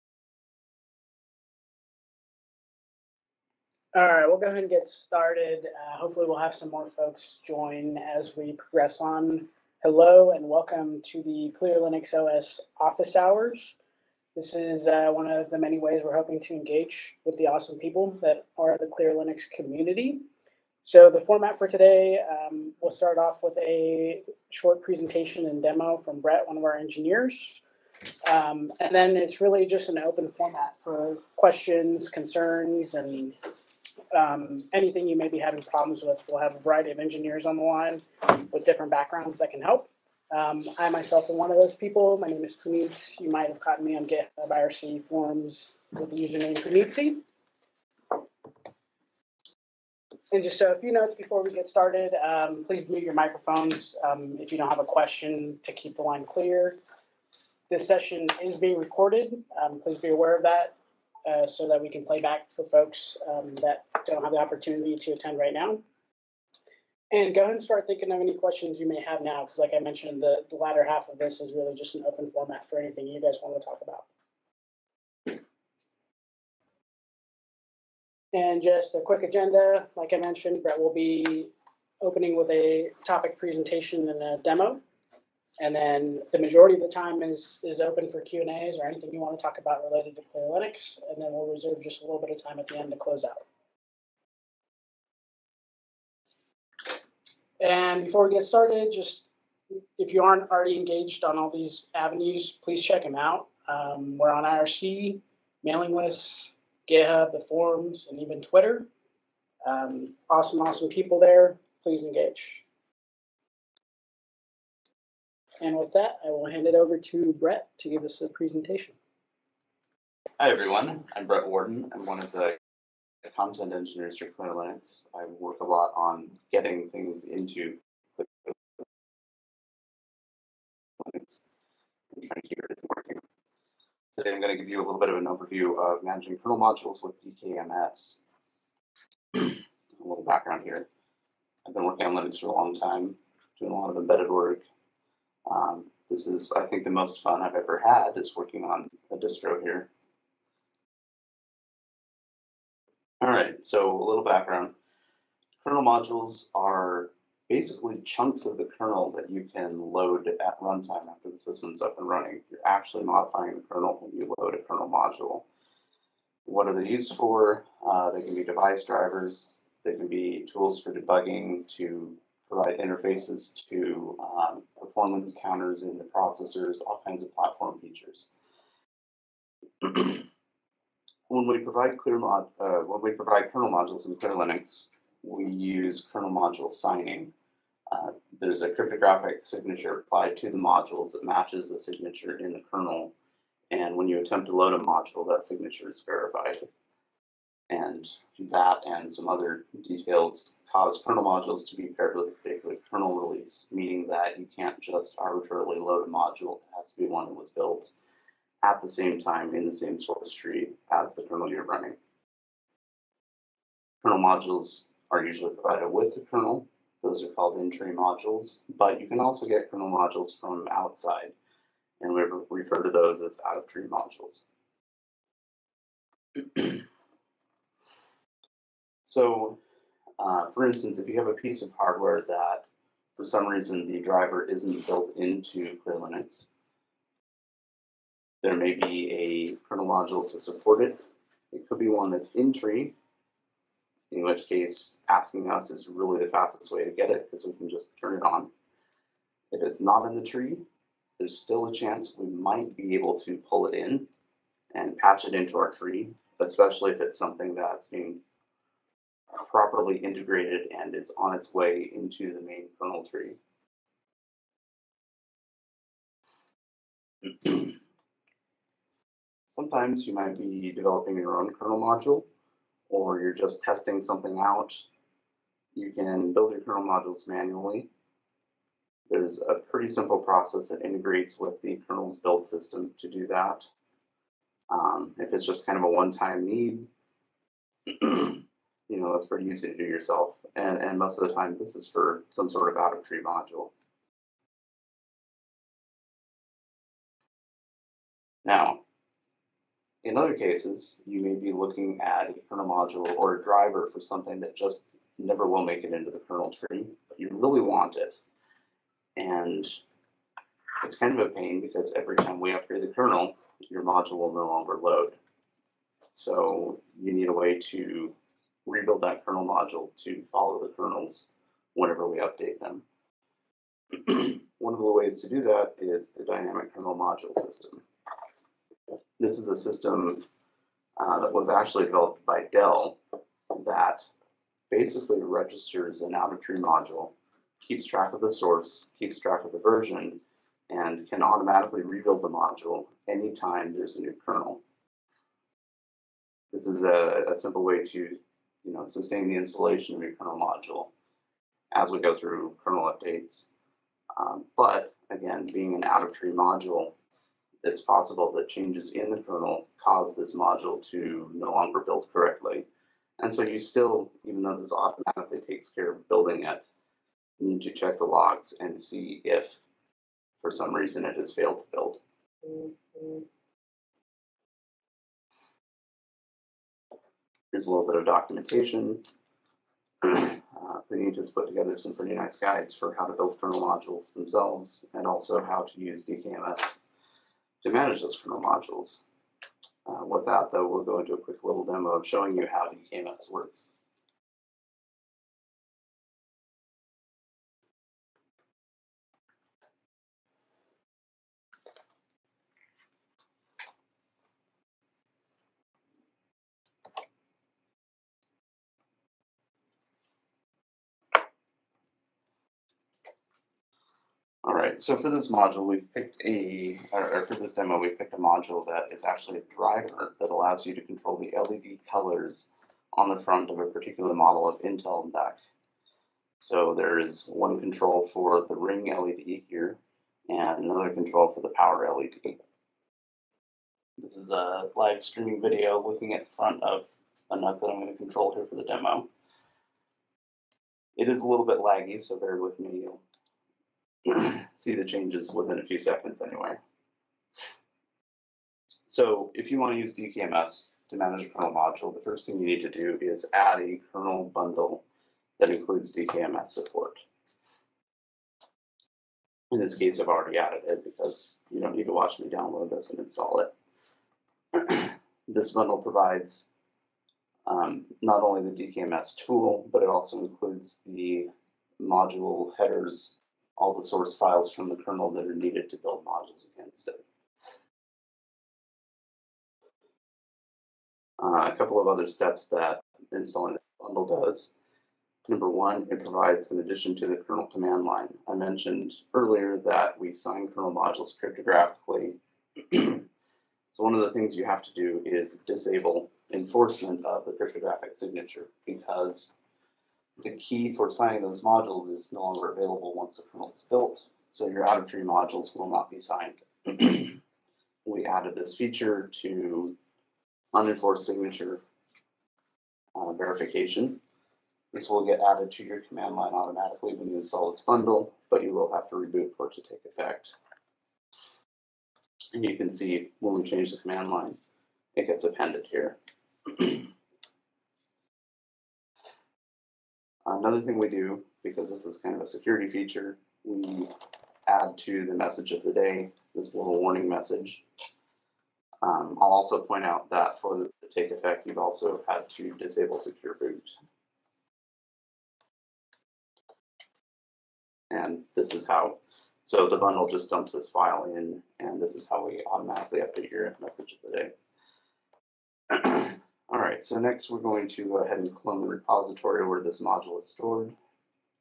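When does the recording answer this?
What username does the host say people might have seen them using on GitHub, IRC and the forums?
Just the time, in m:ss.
0:46.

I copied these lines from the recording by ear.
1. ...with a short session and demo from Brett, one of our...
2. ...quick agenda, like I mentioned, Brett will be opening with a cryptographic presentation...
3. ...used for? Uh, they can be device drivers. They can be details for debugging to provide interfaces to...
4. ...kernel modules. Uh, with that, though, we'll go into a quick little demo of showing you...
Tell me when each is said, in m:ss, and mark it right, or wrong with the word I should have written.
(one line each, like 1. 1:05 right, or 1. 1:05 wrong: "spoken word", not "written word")
1. 0:23 wrong: "presentation", not "session"
2. 1:18 wrong: "topic", not "cryptographic"
3. 2:46 wrong: "tools", not "details"
4. 6:28 right.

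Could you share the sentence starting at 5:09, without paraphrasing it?
And it's kind of a pain because every time we upgrade the kernel, your module will no longer load.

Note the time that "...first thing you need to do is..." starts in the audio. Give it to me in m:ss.
7:32.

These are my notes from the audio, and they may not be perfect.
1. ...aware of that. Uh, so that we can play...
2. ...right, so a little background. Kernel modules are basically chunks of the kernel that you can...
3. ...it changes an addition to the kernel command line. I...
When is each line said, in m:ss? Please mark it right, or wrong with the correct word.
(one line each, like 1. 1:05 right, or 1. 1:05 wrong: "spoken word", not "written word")
1. 1:00 right
2. 2:33 right
3. 8:05 wrong: "provides", not "changes".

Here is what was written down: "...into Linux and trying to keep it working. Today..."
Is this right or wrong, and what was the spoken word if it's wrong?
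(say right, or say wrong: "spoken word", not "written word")
right.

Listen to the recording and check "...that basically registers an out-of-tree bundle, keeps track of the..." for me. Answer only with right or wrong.
wrong.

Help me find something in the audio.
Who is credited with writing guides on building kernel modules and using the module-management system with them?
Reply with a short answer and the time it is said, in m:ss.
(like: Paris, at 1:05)
Puneet, at 6:20.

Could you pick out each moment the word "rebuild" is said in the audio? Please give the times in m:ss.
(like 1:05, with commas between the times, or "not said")
5:18, 5:41.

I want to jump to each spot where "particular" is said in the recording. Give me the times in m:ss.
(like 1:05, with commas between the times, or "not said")
3:22, 7:03.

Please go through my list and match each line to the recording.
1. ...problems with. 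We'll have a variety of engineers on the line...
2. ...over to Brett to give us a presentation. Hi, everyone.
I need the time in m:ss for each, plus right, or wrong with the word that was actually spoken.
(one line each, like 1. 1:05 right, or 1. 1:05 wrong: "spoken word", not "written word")
1. 0:35 right
2. 1:56 right.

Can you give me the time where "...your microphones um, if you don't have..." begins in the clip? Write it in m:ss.
0:53.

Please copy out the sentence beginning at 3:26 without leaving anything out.
It has to be one that was built at the same time in the same source tree as the kernel you're running.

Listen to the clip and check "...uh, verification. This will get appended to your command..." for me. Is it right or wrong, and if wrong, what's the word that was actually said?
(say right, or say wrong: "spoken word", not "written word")
wrong: "added", not "appended".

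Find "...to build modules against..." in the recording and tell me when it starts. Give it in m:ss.
7:55.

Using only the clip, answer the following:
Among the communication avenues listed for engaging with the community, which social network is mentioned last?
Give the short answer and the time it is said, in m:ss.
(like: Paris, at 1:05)
Twitter, at 1:48.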